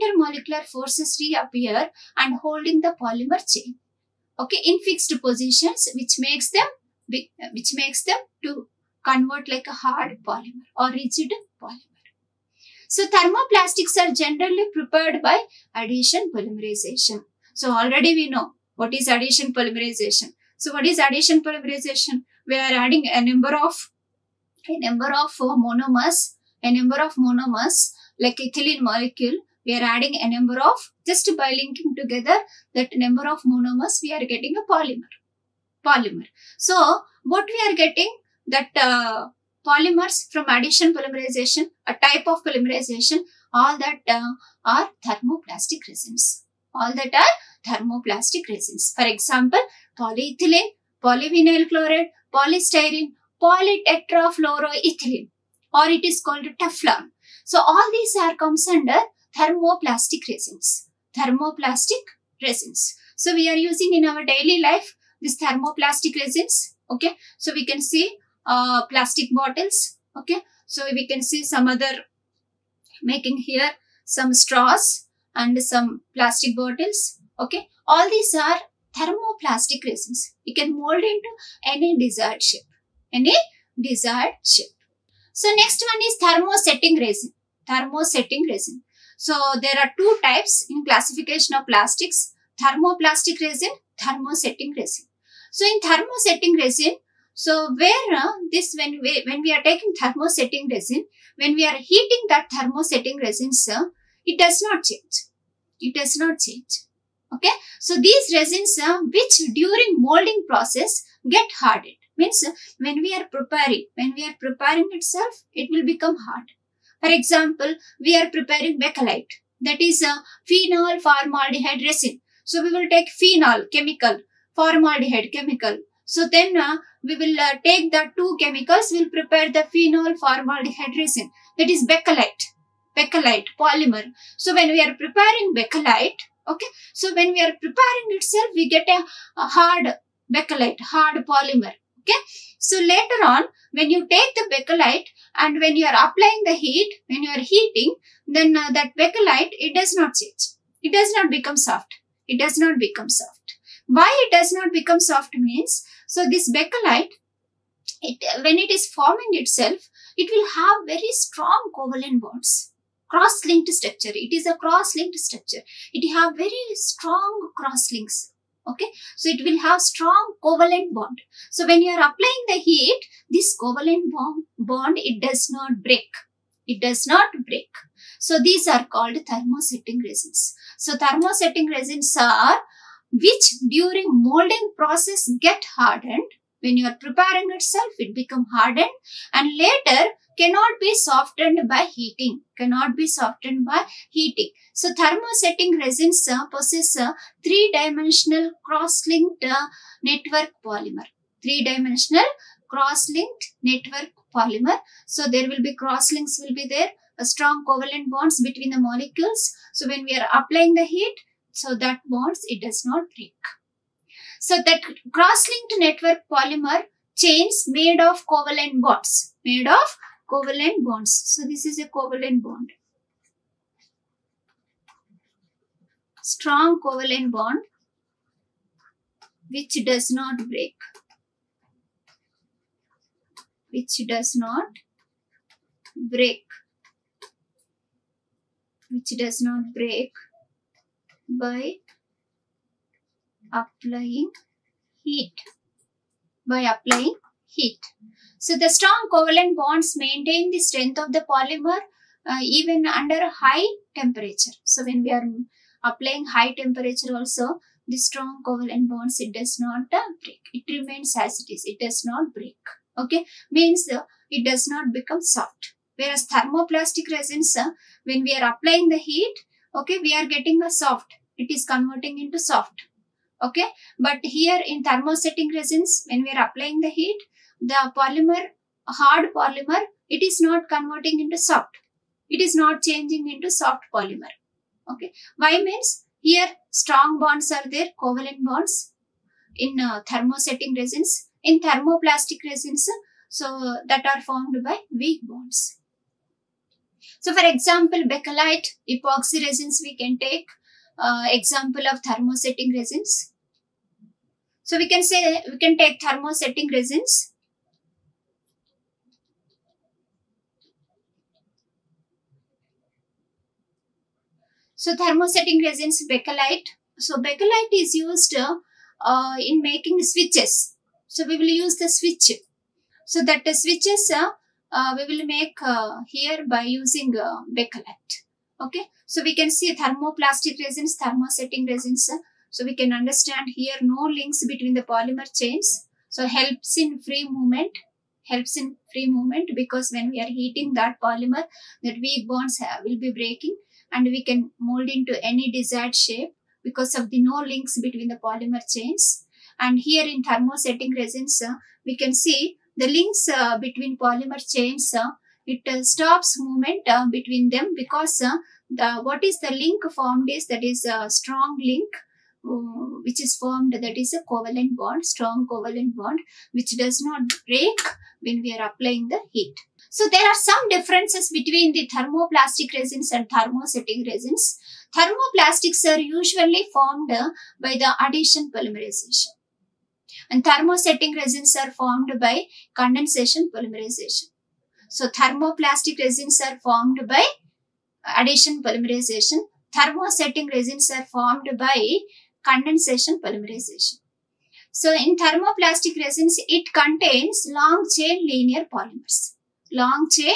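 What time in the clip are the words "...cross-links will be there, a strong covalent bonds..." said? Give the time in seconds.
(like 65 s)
205 s.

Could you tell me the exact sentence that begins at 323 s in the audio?
So that the switches uh, uh, we will make uh, here by using uh, Bakelite.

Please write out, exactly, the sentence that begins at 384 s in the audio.
So thermoplastic resins are formed by addition polymerization.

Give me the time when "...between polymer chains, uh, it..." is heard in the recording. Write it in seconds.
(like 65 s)
353 s.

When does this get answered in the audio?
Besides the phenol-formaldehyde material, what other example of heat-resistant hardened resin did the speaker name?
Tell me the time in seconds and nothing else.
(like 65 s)
298 s.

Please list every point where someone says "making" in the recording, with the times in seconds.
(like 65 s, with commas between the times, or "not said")
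73 s, 319 s.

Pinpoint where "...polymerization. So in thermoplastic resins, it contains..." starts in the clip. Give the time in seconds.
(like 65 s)
393 s.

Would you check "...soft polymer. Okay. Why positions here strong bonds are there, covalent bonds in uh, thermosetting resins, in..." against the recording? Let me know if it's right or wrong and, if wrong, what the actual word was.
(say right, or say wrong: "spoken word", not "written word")
wrong: "means", not "positions".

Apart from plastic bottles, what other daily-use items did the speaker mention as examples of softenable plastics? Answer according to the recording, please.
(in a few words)
Straws.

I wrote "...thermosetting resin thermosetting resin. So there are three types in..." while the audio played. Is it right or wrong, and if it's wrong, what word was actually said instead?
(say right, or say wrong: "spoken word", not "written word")
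wrong: "two", not "three".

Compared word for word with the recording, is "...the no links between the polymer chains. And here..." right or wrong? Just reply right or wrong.
right.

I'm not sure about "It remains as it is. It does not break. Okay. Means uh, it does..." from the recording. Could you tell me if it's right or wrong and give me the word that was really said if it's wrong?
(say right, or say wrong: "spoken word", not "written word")
right.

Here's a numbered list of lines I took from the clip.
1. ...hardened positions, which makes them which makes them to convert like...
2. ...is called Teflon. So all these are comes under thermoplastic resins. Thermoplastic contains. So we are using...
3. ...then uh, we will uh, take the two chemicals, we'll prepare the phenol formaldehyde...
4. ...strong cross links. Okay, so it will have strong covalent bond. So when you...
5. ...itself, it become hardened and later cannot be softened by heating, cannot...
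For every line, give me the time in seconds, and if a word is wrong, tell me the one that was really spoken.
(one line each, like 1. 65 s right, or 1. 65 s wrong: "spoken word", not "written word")
1. 4 s wrong: "fixed", not "hardened"
2. 56 s wrong: "resins", not "contains"
3. 126 s right
4. 166 s right
5. 187 s right.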